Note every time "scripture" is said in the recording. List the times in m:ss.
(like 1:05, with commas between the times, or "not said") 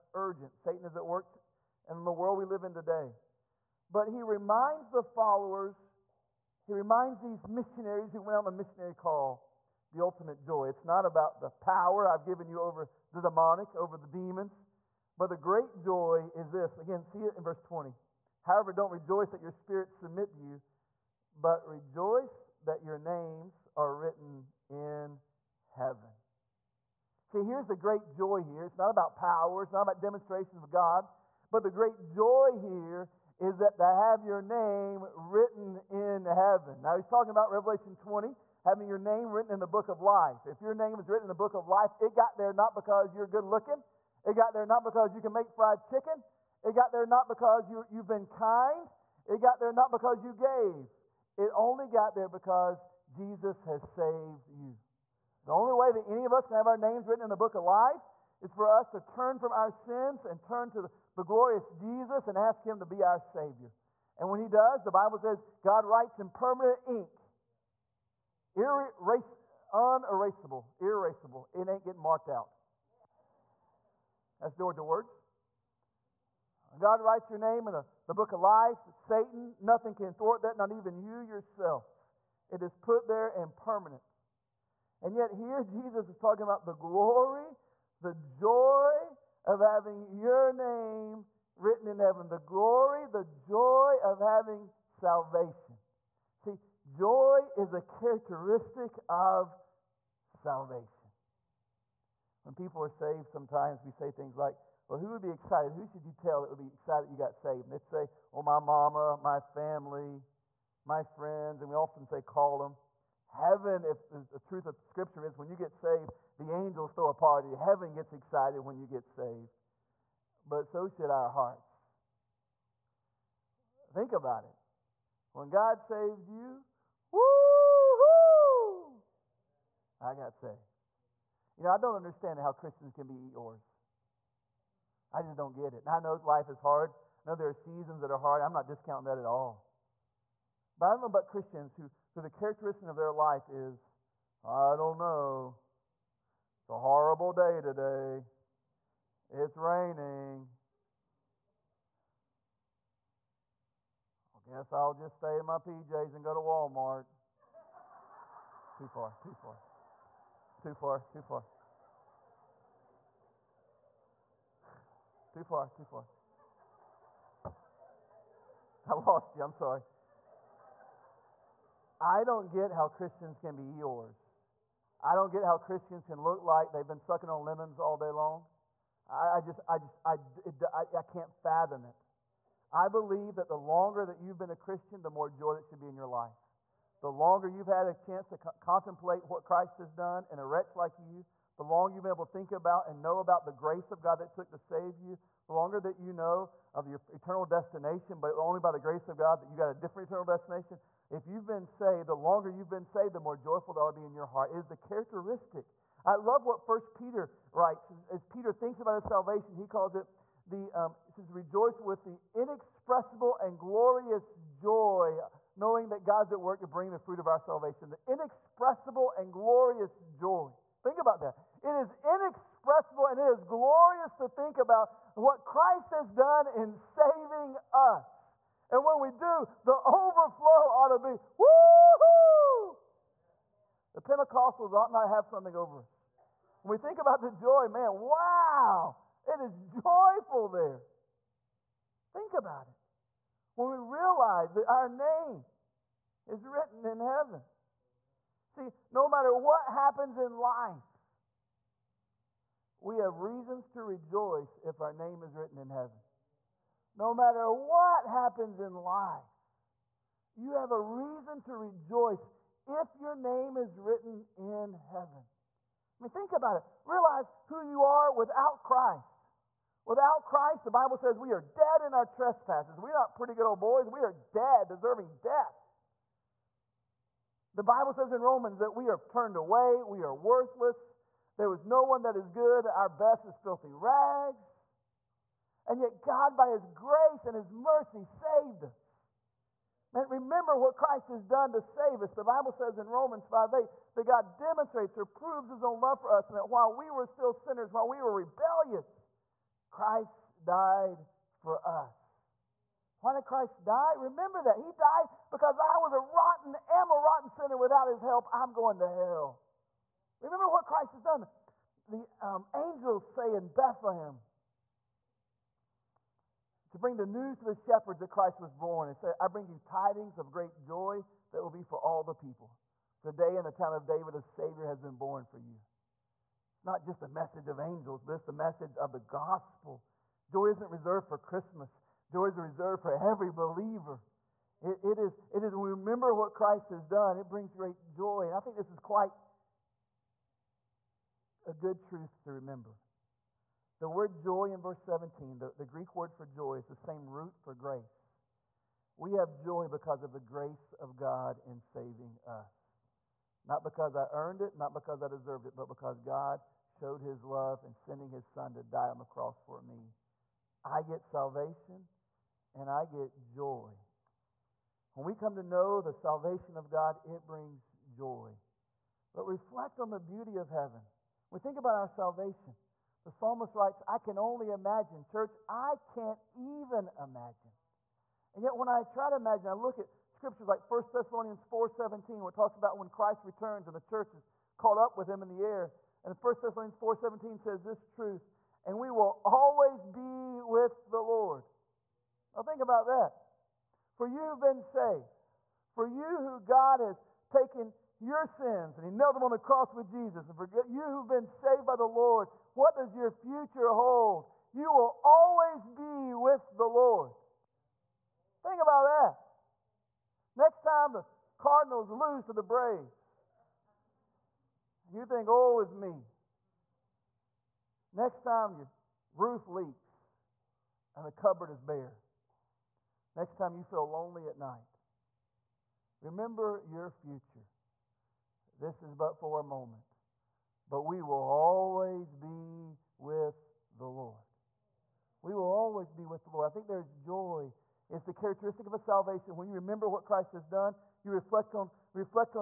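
1:54, 6:20.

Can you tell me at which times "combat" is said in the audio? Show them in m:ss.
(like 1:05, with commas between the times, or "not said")
not said.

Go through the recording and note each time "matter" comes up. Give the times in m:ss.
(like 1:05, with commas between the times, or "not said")
4:09, 4:17.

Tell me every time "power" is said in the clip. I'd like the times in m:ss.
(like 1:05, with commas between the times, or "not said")
0:11, 0:29.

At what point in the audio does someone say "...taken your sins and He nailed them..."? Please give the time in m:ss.
6:37.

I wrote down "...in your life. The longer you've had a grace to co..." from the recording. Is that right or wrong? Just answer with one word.
wrong.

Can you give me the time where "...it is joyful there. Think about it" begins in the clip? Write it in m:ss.
3:59.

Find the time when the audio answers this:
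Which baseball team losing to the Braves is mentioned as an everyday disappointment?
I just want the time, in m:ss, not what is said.
6:51.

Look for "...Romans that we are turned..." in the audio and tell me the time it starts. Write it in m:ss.
4:38.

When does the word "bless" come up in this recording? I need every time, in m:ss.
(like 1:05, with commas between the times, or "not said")
not said.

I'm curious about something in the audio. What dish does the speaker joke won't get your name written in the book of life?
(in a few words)
Fried chicken.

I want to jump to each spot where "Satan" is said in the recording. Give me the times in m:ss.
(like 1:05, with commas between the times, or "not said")
0:00, 1:18.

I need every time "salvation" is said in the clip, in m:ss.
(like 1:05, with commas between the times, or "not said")
1:34, 1:40, 3:29, 3:37, 6:01, 6:05, 6:11, 7:18.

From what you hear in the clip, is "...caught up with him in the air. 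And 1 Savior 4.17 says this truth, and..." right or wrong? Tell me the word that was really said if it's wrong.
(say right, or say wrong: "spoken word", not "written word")
wrong: "Thessalonians", not "Savior".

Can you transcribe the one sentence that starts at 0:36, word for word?
Now, he's talking about Revelation 20, having your name written in the book of life.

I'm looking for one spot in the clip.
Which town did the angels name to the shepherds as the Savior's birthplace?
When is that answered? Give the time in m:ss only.
5:23.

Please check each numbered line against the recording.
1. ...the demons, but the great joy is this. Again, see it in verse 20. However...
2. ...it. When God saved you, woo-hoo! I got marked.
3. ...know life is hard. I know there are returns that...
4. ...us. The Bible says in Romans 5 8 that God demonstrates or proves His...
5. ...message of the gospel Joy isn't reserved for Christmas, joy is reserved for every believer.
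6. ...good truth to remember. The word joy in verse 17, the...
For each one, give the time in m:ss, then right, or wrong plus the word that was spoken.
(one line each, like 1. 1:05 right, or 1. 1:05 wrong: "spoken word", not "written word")
1. 0:13 right
2. 2:04 wrong: "saved", not "marked"
3. 2:15 wrong: "seasons", not "returns"
4. 4:52 right
5. 5:28 right
6. 5:41 right.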